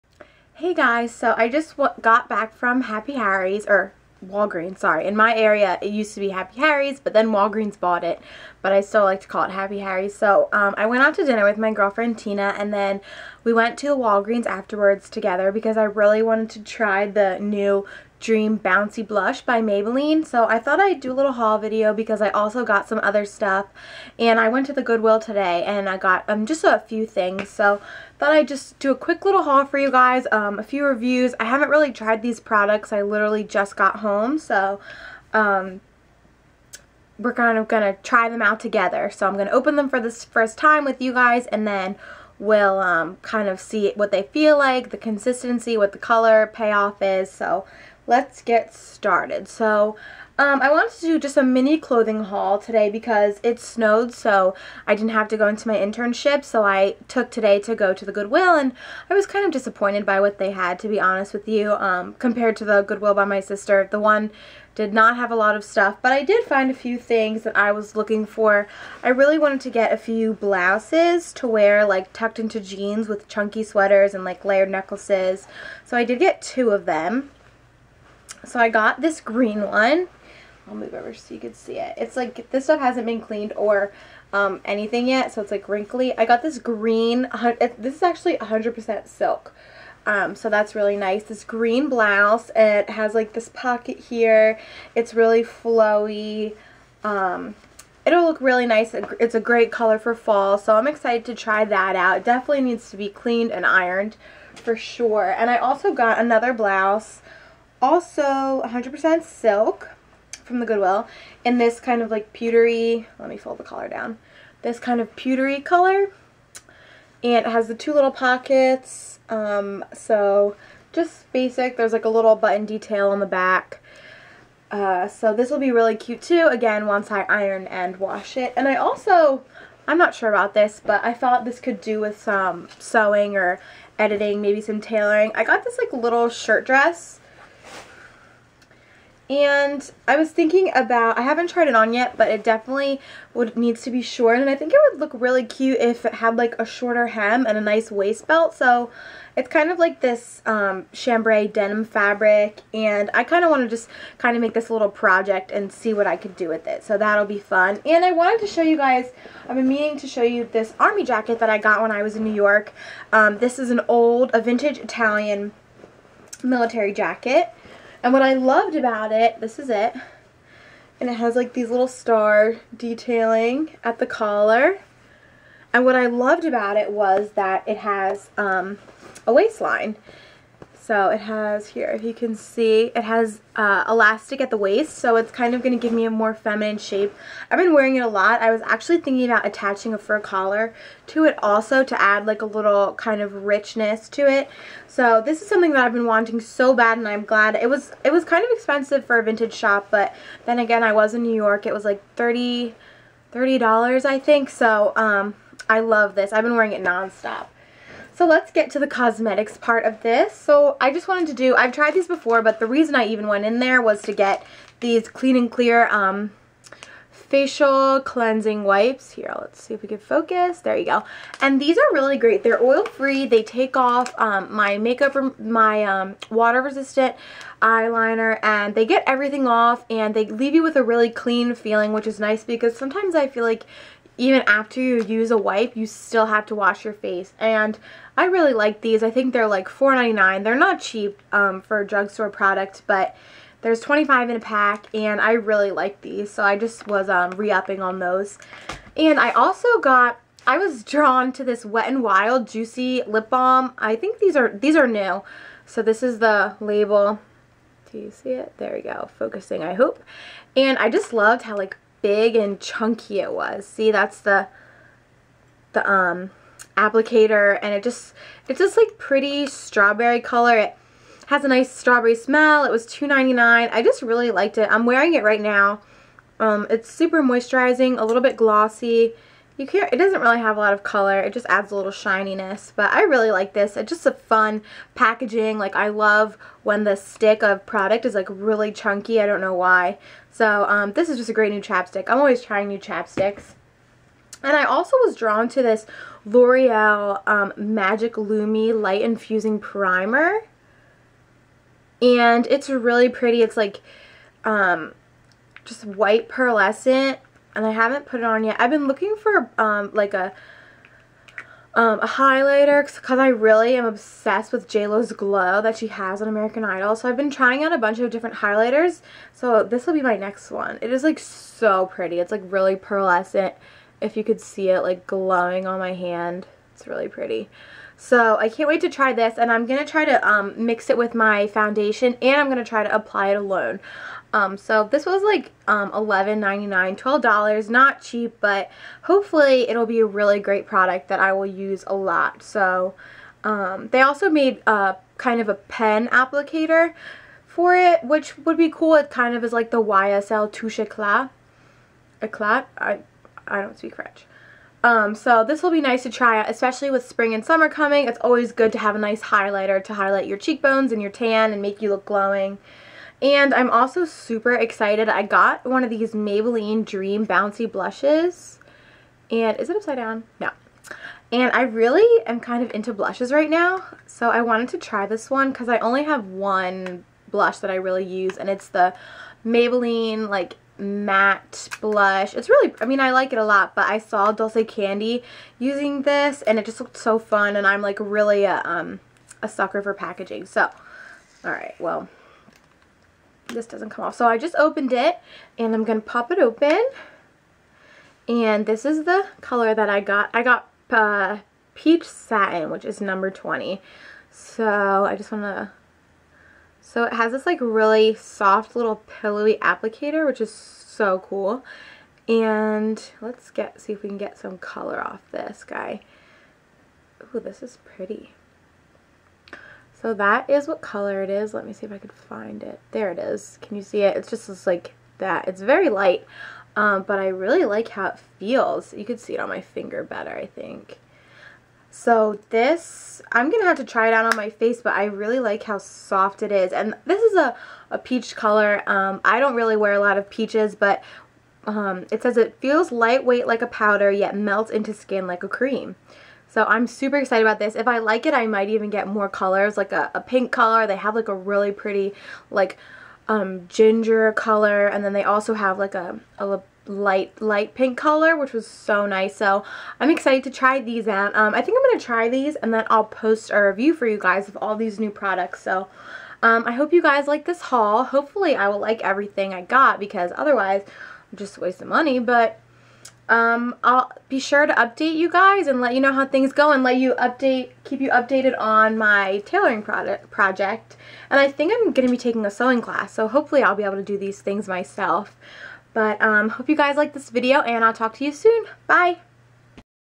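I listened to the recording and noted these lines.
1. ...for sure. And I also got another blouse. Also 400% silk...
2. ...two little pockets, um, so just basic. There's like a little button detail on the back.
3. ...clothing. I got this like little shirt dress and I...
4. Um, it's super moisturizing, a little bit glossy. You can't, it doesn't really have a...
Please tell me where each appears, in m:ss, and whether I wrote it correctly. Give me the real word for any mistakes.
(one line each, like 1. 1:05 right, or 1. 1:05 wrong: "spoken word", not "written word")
1. 1:44 wrong: "100", not "400"
2. 1:57 right
3. 2:14 wrong: "tailoring", not "clothing"
4. 4:36 right.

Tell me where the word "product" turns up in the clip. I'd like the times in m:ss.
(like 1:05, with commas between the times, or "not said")
0:32, 4:02, 4:47, 5:40, 7:45, 7:59.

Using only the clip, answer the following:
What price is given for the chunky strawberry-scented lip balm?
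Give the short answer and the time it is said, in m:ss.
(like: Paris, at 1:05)
$2.99, at 4:32.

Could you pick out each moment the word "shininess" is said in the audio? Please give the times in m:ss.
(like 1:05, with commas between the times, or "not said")
4:41.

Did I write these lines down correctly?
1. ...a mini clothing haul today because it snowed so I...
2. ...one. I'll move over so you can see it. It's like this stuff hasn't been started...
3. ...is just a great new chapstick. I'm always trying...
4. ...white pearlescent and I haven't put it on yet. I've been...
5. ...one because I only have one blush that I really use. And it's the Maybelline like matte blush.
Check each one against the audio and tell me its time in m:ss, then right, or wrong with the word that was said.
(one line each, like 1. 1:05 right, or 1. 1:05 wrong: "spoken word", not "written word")
1. 0:51 right
2. 1:19 wrong: "cleaned", not "started"
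3. 4:51 right
4. 5:05 right
5. 6:15 right.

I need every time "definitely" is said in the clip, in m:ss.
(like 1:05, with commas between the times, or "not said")
1:42, 2:22.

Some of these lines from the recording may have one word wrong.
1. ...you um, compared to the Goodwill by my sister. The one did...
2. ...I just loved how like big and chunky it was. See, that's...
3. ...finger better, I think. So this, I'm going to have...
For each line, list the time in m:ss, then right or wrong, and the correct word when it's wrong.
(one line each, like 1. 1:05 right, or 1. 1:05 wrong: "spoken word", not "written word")
1. 1:01 right
2. 4:20 right
3. 7:09 right.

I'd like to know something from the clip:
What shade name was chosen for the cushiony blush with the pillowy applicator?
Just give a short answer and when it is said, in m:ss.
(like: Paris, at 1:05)
Peach Satin, at 6:41.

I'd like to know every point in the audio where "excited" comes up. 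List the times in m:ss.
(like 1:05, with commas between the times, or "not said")
1:40, 6:04, 7:27, 7:40.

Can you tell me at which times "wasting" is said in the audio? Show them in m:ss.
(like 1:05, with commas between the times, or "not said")
7:51.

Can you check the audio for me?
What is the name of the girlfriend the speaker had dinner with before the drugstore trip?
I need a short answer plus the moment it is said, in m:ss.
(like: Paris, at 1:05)
Tina, at 0:12.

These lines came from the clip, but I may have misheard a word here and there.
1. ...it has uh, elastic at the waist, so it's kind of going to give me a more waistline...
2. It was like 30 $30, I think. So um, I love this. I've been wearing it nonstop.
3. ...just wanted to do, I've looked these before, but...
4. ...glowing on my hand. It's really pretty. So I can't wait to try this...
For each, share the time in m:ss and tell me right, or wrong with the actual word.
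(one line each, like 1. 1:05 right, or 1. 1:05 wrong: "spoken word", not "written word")
1. 3:02 wrong: "feminine", not "waistline"
2. 3:21 right
3. 3:30 wrong: "tried", not "looked"
4. 5:25 right.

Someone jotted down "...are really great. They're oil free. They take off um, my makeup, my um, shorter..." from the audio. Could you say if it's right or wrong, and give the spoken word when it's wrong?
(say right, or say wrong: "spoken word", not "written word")
wrong: "water", not "shorter".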